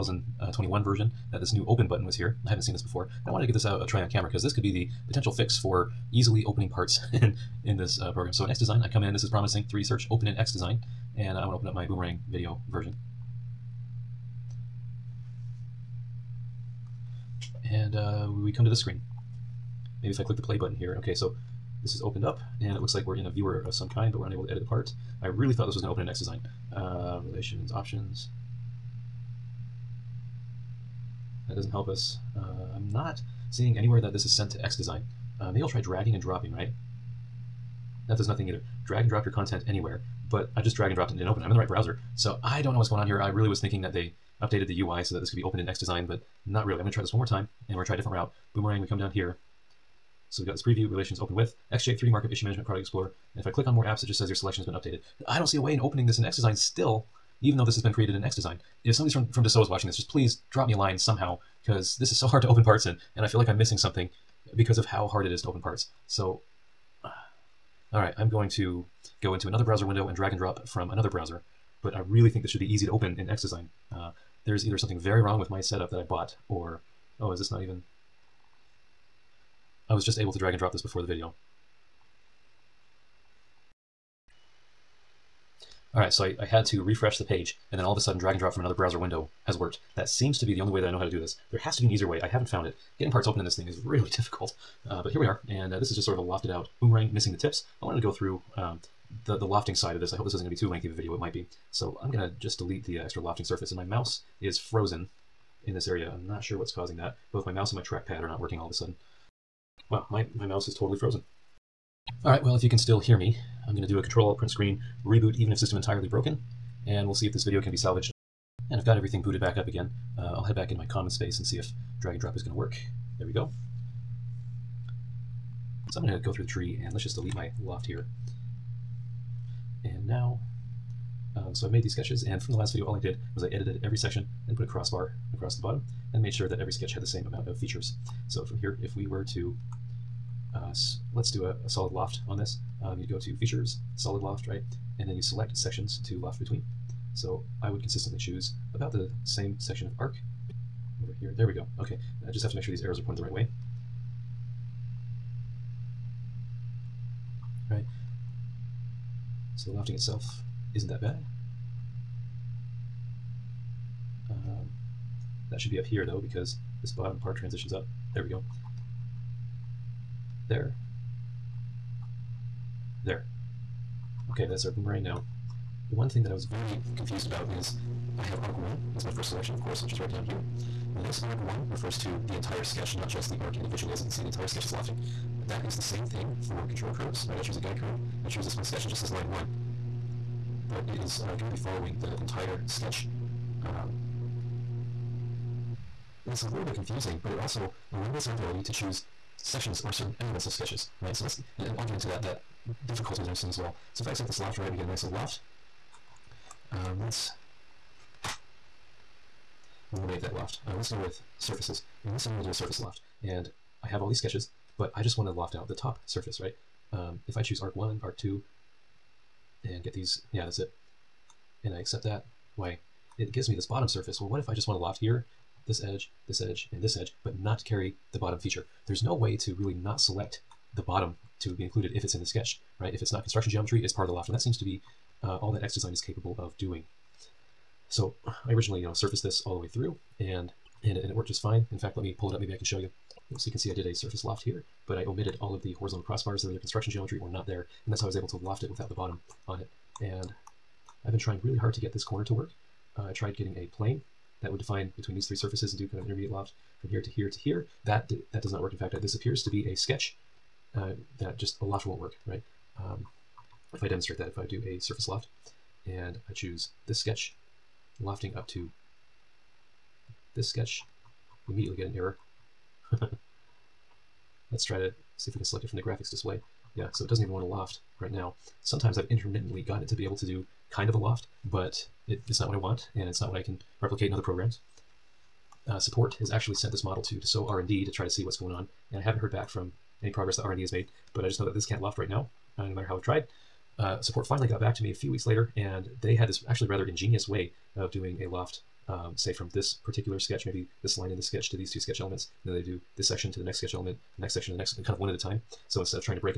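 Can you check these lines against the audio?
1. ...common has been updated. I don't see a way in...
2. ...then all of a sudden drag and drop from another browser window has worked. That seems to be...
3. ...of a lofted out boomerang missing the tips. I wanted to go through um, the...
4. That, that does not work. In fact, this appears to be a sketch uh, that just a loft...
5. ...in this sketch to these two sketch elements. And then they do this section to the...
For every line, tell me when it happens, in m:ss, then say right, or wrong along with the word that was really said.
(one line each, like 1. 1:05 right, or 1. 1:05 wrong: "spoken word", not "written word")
1. 0:54 wrong: "selection", not "common"
2. 1:27 right
3. 1:36 right
4. 4:17 right
5. 5:01 right.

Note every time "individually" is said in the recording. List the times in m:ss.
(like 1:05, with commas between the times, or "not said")
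3:03.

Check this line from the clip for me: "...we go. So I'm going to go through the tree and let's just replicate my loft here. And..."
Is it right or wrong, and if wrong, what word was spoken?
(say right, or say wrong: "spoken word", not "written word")
wrong: "delete", not "replicate".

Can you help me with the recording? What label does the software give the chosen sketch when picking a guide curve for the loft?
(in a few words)
Line one.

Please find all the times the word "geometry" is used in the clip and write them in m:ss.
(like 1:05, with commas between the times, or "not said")
3:53, 4:06.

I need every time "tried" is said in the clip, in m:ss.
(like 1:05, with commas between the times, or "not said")
4:13, 4:53.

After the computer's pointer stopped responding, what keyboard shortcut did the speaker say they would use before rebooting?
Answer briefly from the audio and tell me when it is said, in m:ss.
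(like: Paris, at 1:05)
Control print screen, at 1:54.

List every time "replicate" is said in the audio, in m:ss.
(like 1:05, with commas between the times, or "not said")
4:43.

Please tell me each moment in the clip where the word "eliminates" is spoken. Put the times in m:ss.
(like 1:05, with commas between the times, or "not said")
3:17, 3:29.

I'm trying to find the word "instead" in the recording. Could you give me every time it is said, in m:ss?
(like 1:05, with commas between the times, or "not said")
5:05.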